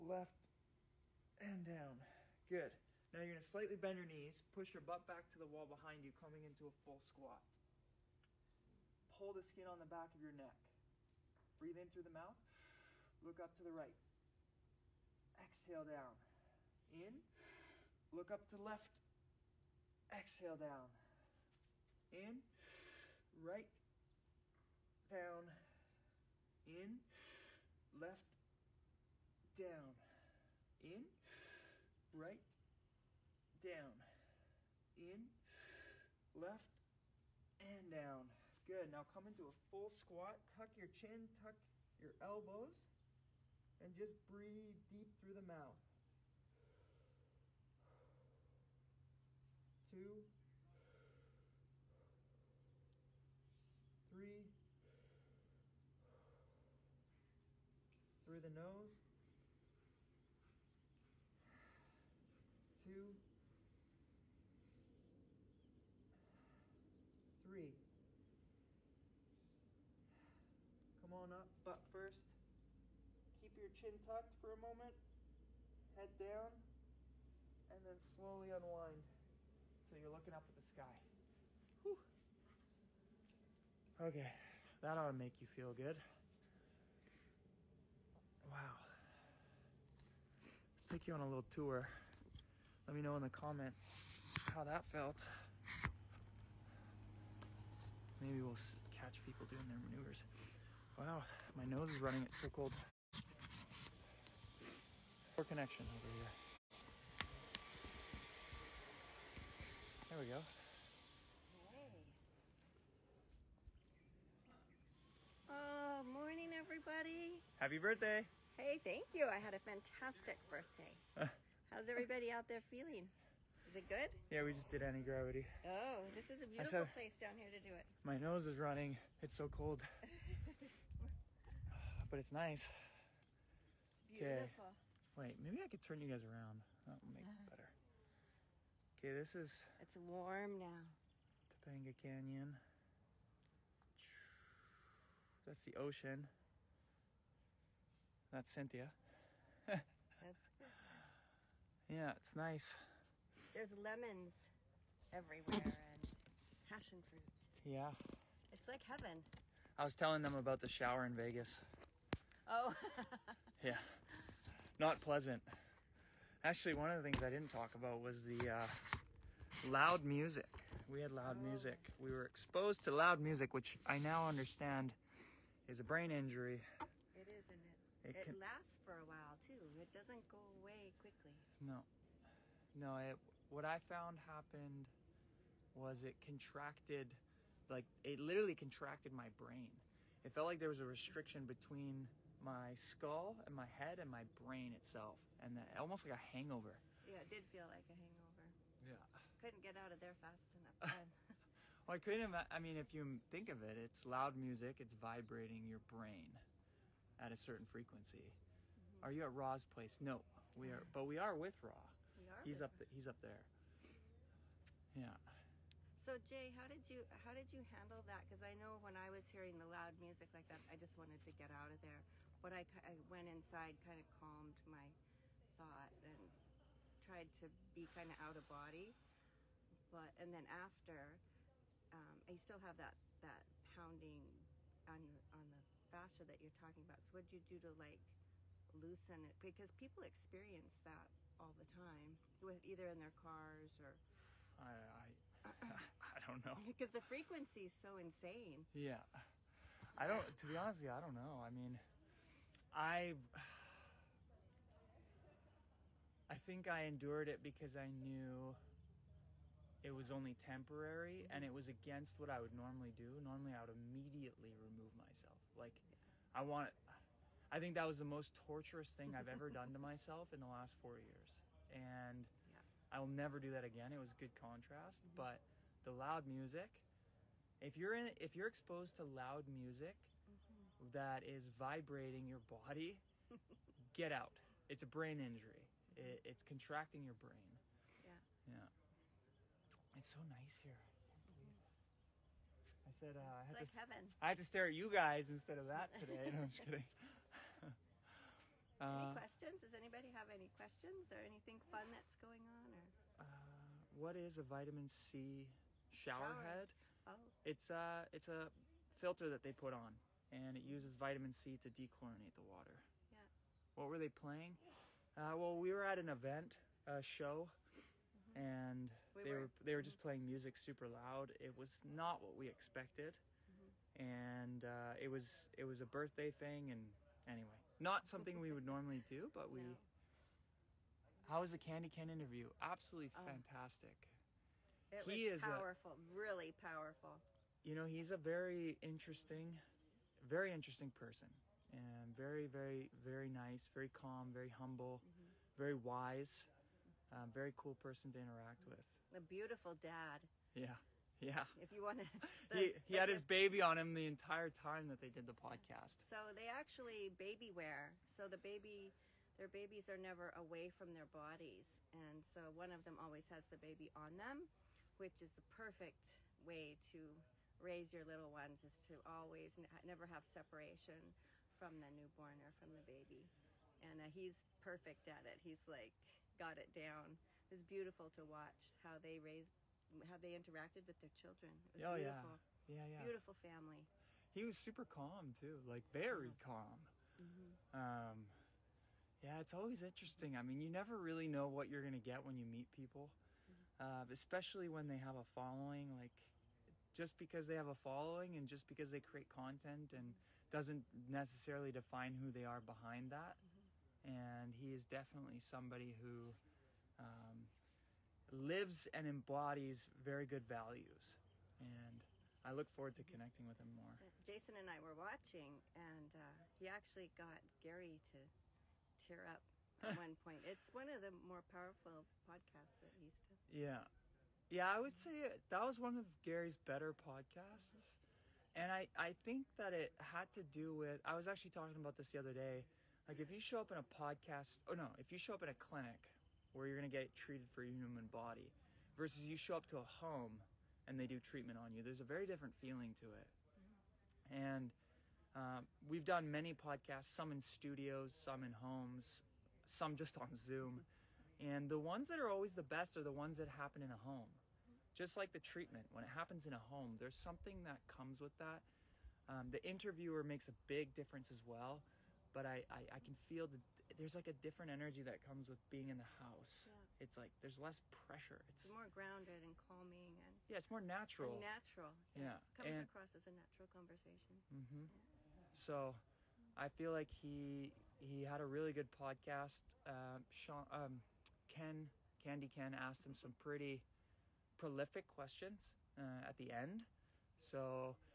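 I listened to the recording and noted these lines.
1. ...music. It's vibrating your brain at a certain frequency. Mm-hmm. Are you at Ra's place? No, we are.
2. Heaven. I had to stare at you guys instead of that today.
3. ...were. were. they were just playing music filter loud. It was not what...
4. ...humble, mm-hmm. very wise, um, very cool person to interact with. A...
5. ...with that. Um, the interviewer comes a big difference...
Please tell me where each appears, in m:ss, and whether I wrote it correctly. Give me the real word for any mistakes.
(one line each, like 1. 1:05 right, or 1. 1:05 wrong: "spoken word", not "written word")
1. 3:24 right
2. 4:53 right
3. 5:19 wrong: "super", not "filter"
4. 5:44 right
5. 7:38 wrong: "makes", not "comes".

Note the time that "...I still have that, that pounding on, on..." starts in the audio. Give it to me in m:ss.
3:52.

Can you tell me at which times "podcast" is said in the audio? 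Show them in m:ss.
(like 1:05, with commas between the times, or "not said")
5:55, 7:02, 7:06, 7:13, 7:26, 7:58.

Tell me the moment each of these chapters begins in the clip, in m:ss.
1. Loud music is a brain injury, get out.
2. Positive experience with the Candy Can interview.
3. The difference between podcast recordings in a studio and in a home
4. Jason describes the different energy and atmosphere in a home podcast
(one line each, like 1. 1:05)
1. 3:34
2. 5:36
3. 7:30
4. 7:47.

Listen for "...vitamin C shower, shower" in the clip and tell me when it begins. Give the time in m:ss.
5:04.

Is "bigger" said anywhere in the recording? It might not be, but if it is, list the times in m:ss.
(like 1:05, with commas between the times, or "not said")
not said.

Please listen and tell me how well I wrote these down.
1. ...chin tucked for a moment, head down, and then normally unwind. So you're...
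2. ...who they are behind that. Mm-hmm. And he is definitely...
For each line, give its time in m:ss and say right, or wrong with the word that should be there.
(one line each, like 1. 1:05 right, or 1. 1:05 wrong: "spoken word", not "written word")
1. 1:13 wrong: "slowly", not "normally"
2. 6:42 right.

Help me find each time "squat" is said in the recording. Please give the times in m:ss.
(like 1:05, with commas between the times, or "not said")
0:06, 0:39.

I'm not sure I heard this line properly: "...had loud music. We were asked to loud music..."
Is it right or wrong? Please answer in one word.
wrong.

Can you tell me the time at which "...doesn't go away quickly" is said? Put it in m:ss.
2:59.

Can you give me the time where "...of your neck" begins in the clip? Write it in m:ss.
0:10.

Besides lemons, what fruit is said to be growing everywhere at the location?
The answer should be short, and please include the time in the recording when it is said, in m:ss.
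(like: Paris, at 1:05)
Passion fruit, at 2:36.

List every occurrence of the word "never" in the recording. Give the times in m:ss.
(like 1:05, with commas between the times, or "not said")
4:33, 5:59, 6:09, 6:30.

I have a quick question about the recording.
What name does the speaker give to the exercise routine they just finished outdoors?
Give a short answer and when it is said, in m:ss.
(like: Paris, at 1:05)
Anti-gravity, at 2:04.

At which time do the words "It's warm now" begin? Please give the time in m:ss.
2:19.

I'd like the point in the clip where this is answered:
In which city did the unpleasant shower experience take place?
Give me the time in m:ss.
2:41.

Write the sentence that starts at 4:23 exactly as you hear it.
Normally, I would immediately remove myself.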